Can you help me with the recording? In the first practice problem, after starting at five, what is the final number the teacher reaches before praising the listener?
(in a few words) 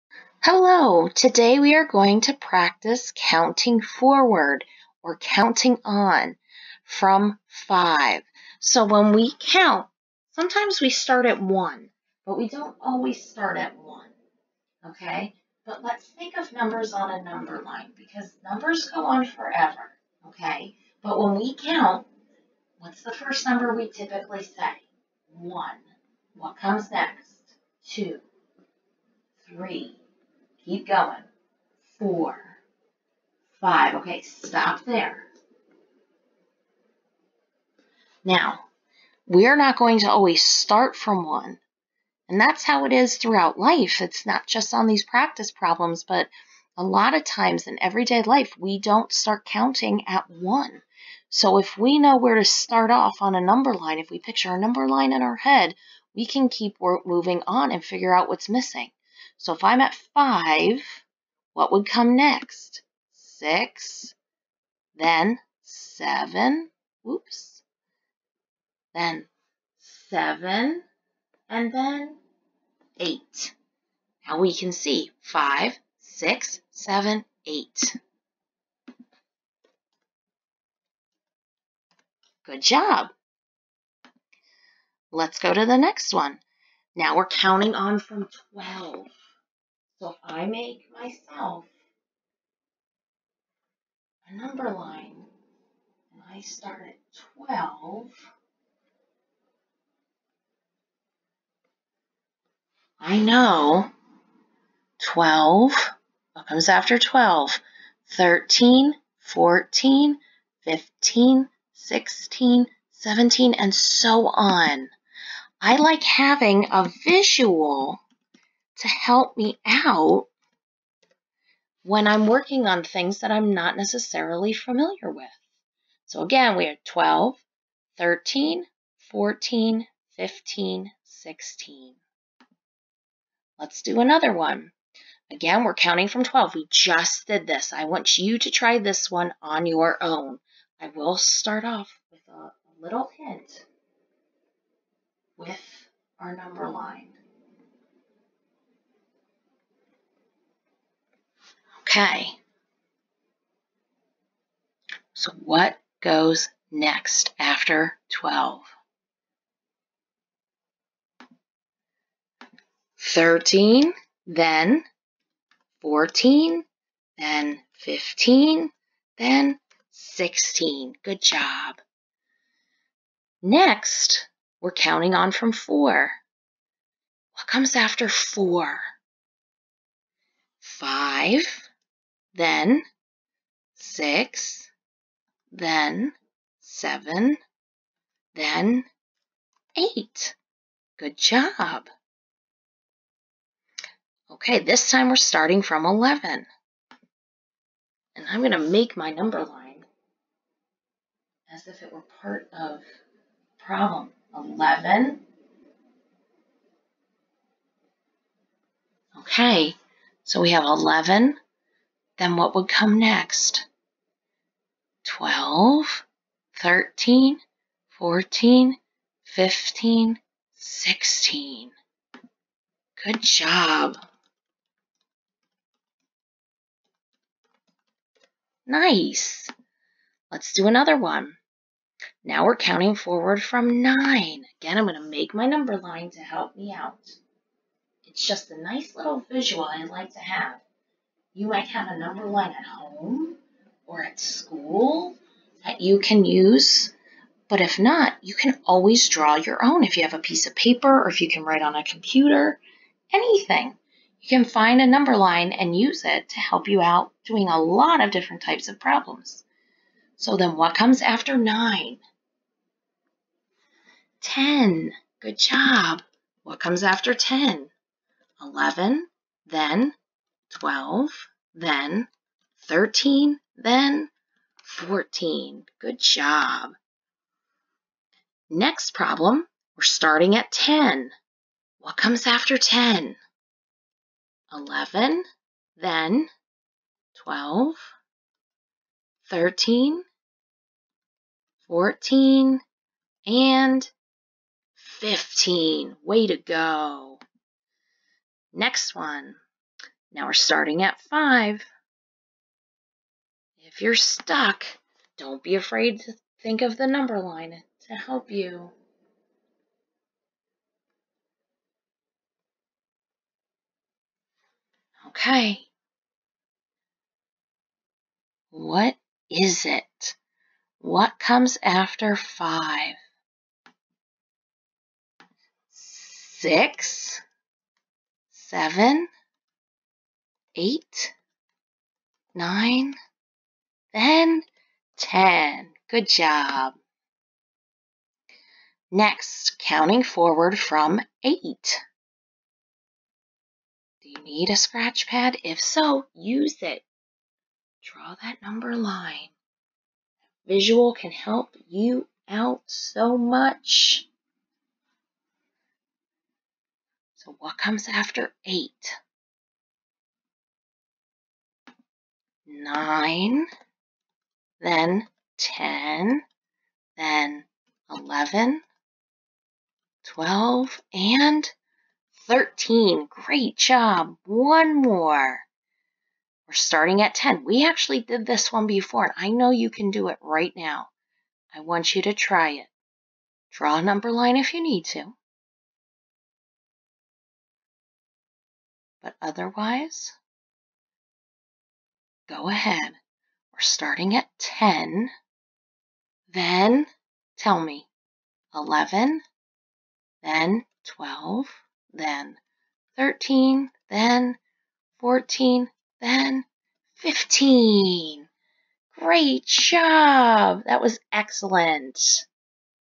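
8.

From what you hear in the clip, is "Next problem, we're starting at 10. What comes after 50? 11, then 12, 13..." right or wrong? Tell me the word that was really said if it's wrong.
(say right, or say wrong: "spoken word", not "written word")
wrong: "10", not "50".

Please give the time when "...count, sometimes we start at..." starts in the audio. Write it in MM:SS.
00:09.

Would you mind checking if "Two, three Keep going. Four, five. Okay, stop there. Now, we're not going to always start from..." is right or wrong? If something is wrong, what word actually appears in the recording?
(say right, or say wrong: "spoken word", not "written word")
right.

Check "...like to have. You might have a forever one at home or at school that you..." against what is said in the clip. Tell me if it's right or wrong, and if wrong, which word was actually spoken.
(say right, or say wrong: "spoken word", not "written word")
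wrong: "number", not "forever".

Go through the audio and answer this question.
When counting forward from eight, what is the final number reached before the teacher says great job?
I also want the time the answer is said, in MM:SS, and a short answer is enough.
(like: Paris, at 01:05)
13, at 06:10.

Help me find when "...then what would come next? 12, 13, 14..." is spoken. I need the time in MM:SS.
03:32.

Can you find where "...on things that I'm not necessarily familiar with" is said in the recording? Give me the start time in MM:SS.
02:02.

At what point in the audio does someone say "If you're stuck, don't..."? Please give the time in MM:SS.
05:03.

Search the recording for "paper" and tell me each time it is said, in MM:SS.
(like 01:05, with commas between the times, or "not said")
04:10.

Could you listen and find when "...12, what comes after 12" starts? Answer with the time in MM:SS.
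01:45.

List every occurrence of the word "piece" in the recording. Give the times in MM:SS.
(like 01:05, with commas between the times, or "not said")
04:10.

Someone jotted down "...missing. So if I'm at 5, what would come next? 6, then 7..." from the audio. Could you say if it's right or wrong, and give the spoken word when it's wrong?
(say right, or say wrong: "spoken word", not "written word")
right.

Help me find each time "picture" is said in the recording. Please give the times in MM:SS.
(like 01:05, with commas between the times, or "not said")
00:54.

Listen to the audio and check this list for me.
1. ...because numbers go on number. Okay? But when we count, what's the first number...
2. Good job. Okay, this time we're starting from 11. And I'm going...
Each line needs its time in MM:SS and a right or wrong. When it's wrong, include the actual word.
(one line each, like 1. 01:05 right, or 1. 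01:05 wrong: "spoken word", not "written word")
1. 00:17 wrong: "forever", not "number"
2. 03:10 right.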